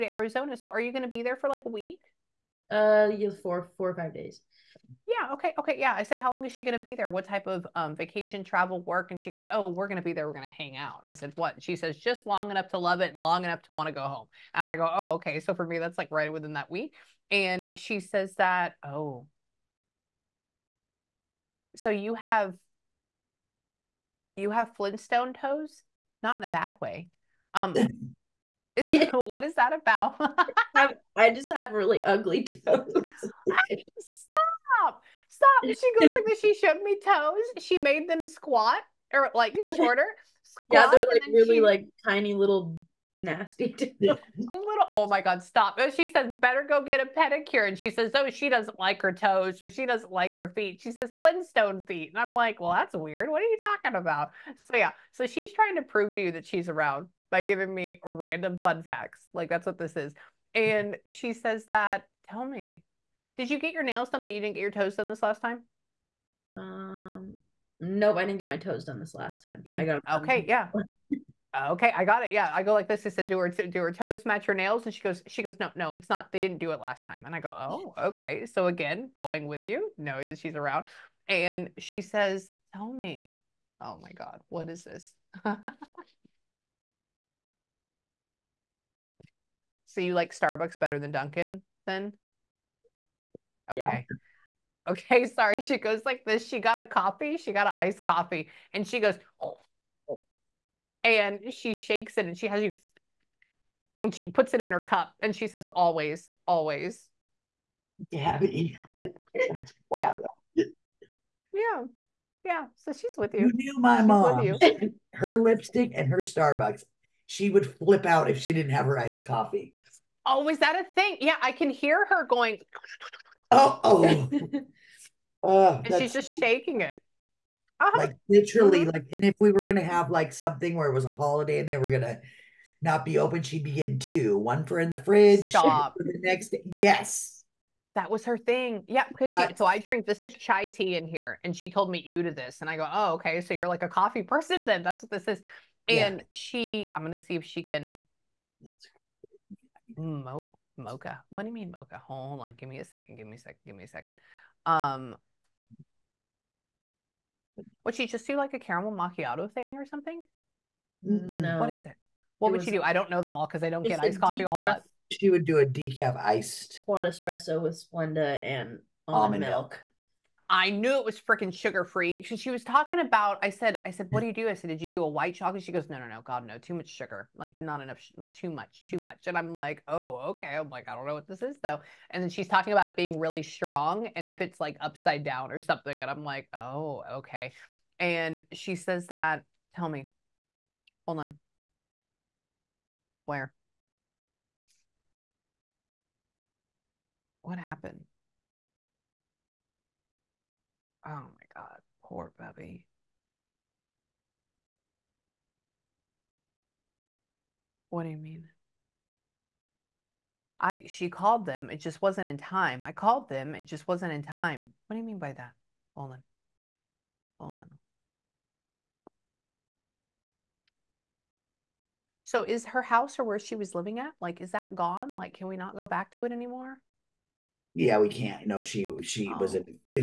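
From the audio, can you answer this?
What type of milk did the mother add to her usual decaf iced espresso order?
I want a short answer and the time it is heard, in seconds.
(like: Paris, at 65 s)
Almond milk, at 169 s.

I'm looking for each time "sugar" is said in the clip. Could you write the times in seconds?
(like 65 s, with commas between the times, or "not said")
171 s, 176 s.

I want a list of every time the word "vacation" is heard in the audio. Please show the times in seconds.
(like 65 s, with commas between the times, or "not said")
7 s.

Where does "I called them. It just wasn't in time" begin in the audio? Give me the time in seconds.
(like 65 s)
212 s.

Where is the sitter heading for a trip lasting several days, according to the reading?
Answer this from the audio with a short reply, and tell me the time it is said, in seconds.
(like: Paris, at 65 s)
Arizona, at 0 s.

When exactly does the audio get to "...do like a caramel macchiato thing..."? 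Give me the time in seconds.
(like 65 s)
158 s.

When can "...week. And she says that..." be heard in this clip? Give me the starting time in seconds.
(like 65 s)
16 s.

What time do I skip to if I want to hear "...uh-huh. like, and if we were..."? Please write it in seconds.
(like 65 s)
128 s.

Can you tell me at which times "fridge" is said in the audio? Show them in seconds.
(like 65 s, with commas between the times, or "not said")
134 s.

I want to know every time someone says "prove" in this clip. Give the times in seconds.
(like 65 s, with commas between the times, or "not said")
55 s.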